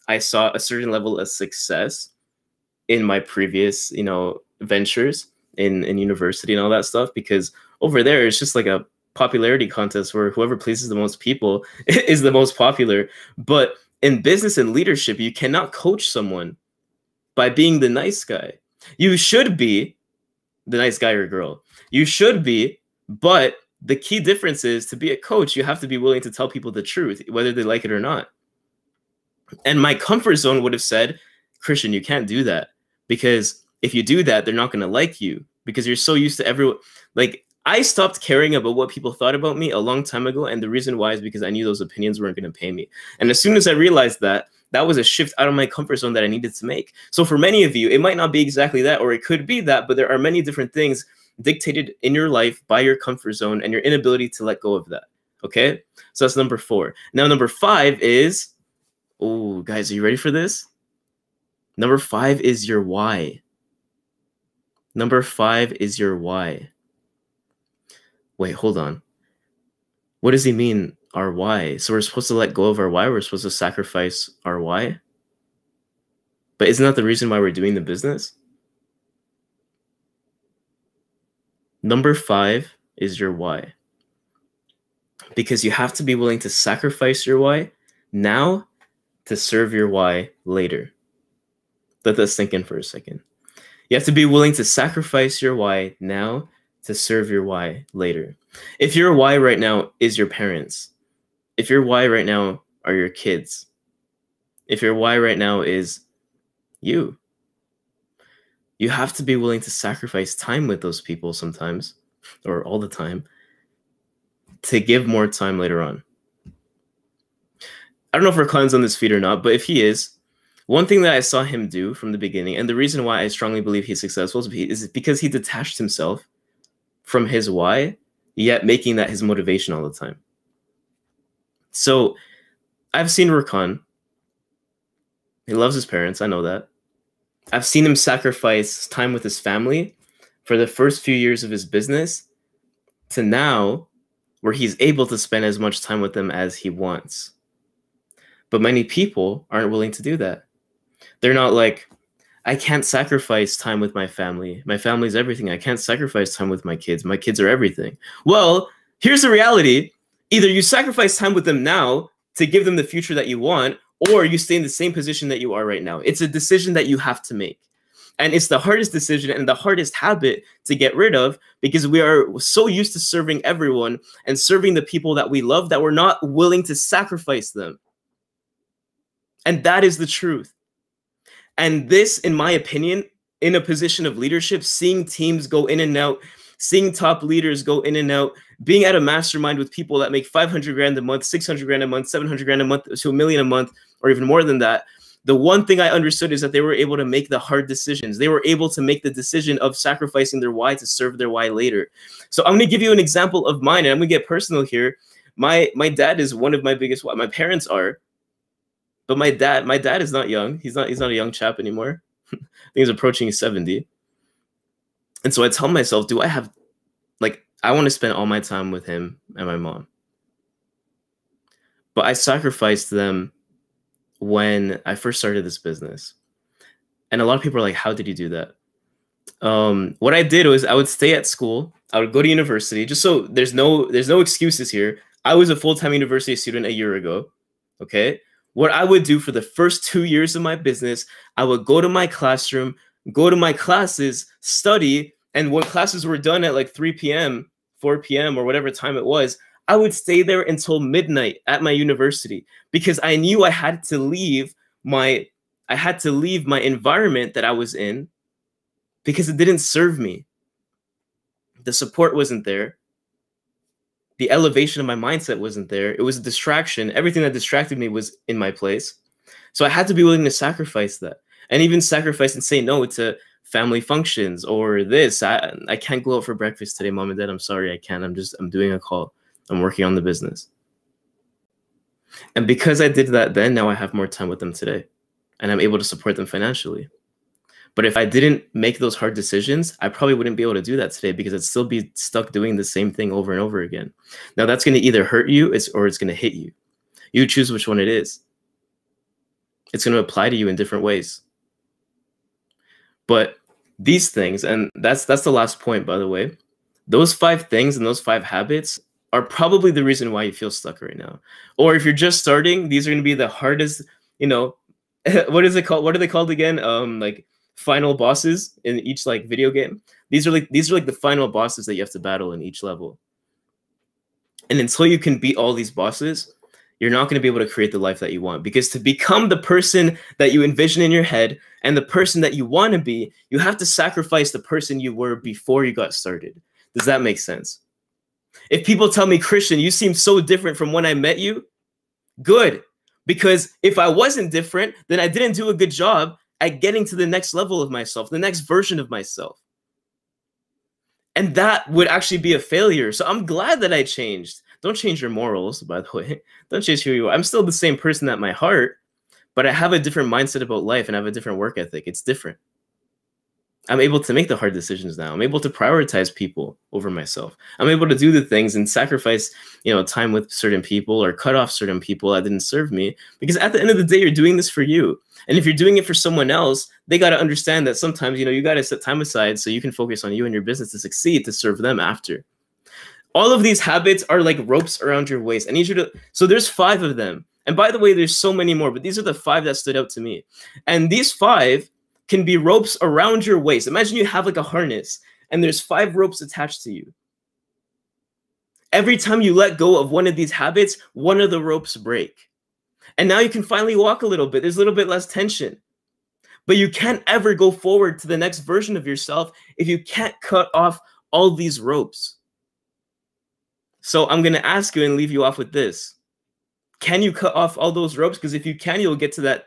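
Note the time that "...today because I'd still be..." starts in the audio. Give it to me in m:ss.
4:50.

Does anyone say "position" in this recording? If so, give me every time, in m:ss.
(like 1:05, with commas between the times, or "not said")
2:44, 3:03.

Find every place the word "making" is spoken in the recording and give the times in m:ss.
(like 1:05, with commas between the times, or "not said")
2:08.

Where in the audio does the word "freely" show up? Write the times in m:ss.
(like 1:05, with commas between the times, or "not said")
not said.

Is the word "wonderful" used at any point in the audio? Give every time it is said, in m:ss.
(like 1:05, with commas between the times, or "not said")
not said.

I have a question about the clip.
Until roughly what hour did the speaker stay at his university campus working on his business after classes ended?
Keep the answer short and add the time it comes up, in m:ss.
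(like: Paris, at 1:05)
Midnight, at 4:10.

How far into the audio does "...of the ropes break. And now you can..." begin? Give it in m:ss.
6:41.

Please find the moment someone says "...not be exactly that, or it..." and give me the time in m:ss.
0:48.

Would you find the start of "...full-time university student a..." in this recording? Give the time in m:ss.
3:55.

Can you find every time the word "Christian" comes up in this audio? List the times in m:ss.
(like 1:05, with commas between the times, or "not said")
0:31, 5:39.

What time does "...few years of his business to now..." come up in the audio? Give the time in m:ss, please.
2:21.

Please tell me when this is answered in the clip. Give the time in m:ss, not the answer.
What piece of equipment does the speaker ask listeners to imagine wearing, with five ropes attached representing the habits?
6:34.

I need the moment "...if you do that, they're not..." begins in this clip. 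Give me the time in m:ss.
0:33.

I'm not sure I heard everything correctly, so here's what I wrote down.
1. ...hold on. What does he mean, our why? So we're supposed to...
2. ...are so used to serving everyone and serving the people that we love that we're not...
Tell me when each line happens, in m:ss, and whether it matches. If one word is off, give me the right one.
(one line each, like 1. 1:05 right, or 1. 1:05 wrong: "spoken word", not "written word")
1. 1:08 right
2. 2:52 right.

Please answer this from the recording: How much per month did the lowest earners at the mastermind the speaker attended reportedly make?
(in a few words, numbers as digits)
500 grand.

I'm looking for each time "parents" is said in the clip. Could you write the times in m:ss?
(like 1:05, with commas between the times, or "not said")
1:40, 2:15, 3:27.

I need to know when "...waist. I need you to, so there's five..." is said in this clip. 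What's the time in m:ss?
6:25.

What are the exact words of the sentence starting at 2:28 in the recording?
But many people aren't willing to do that.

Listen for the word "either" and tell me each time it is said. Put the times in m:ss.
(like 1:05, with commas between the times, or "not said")
2:40, 4:54.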